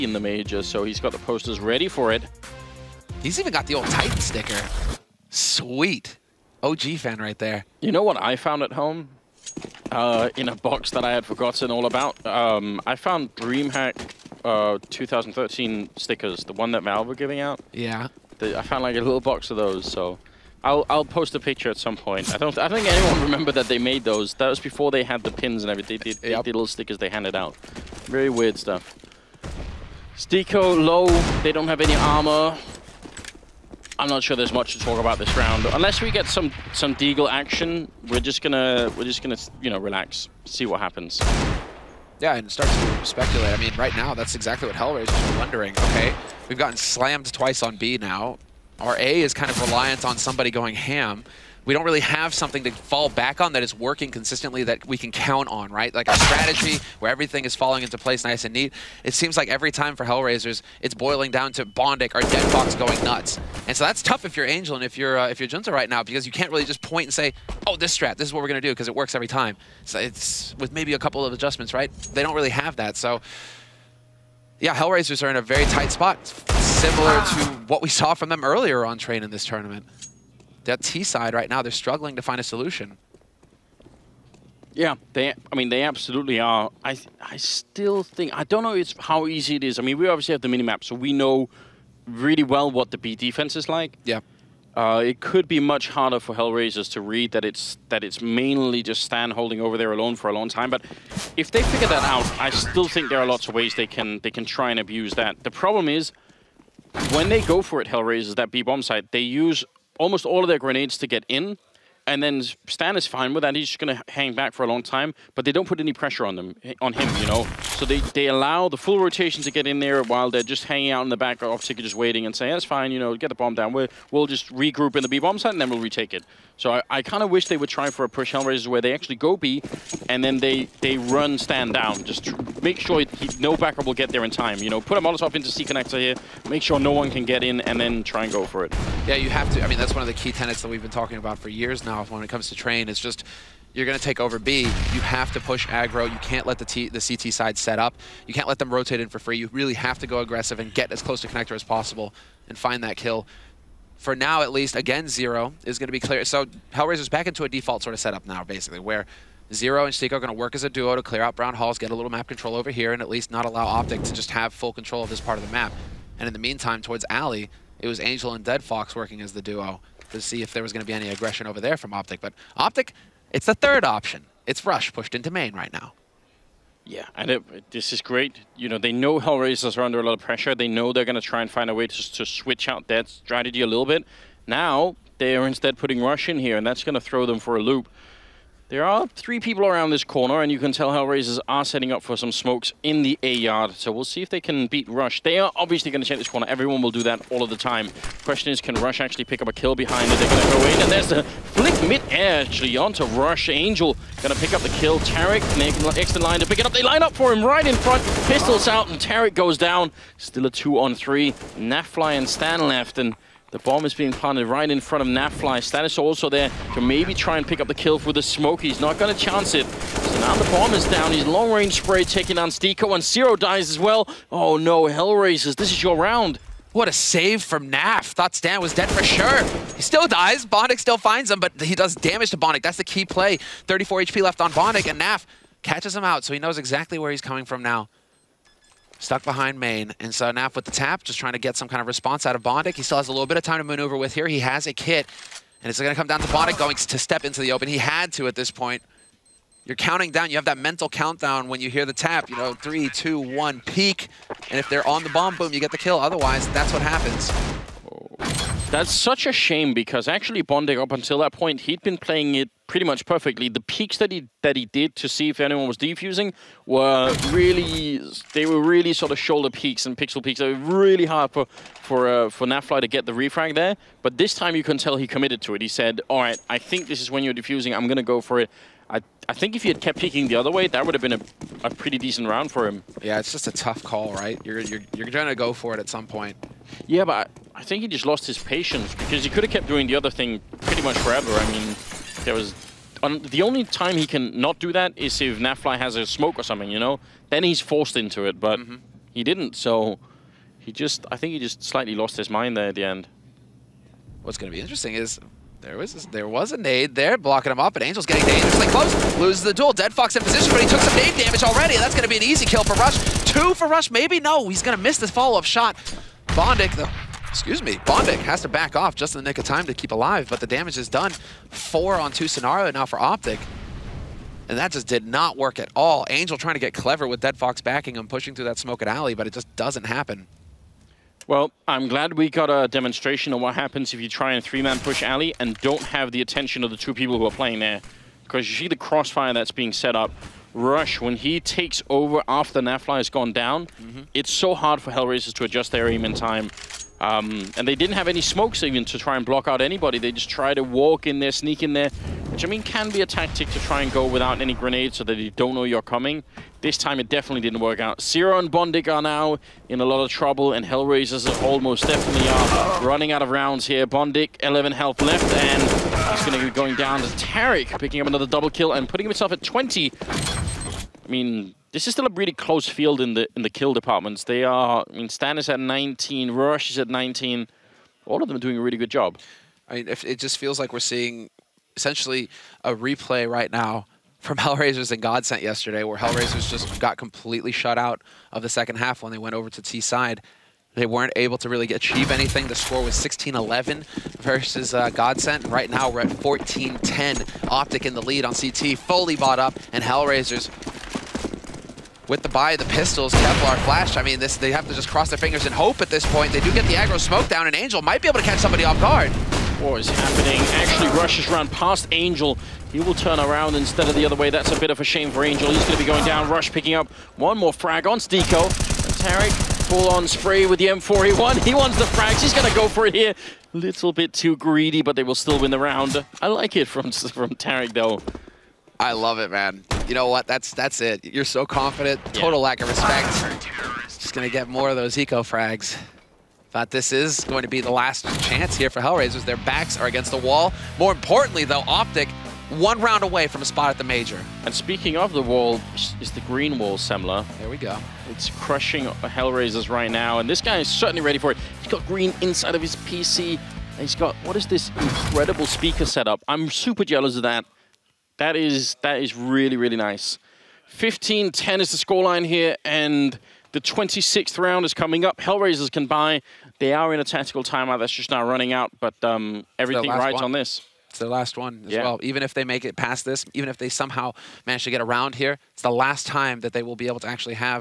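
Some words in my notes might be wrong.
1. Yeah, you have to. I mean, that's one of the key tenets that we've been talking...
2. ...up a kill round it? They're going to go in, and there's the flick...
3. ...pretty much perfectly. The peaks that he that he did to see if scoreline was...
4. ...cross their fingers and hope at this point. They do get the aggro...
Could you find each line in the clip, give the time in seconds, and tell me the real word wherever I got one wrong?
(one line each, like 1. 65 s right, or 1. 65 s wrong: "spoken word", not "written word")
1. 139 s right
2. 199 s wrong: "behind", not "round"
3. 262 s wrong: "anyone", not "scoreline"
4. 404 s right.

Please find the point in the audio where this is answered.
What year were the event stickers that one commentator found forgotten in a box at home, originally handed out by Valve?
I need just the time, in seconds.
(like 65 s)
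14 s.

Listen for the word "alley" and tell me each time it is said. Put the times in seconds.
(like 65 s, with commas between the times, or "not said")
167 s, 328 s, 335 s.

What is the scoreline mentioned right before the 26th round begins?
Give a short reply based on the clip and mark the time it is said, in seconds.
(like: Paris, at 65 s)
15-10, at 460 s.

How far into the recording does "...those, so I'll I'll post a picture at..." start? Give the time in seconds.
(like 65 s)
19 s.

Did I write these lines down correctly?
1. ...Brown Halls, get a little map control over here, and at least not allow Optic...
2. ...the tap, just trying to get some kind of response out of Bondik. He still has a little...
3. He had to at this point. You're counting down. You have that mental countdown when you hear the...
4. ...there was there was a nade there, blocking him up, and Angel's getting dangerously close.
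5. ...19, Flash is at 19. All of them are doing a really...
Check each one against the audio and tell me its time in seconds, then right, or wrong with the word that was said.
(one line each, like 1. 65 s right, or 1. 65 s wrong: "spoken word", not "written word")
1. 161 s right
2. 240 s right
3. 247 s right
4. 305 s right
5. 375 s wrong: "Rush", not "Flash".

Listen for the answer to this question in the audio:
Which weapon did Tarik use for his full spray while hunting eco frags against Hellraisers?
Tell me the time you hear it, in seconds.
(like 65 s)
420 s.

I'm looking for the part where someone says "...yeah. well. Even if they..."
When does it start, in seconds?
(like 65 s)
471 s.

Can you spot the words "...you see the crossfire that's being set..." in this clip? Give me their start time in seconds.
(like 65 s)
338 s.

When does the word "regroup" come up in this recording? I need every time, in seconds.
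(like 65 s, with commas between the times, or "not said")
124 s.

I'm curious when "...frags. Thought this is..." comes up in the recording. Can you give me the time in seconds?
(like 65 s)
435 s.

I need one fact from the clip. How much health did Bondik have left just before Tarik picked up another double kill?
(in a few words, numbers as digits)
11.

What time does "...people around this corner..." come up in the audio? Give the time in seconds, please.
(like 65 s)
189 s.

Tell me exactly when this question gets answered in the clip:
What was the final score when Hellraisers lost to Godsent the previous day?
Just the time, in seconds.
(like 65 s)
392 s.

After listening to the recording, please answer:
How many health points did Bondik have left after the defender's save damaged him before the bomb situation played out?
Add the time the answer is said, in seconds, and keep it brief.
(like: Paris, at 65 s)
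34, at 233 s.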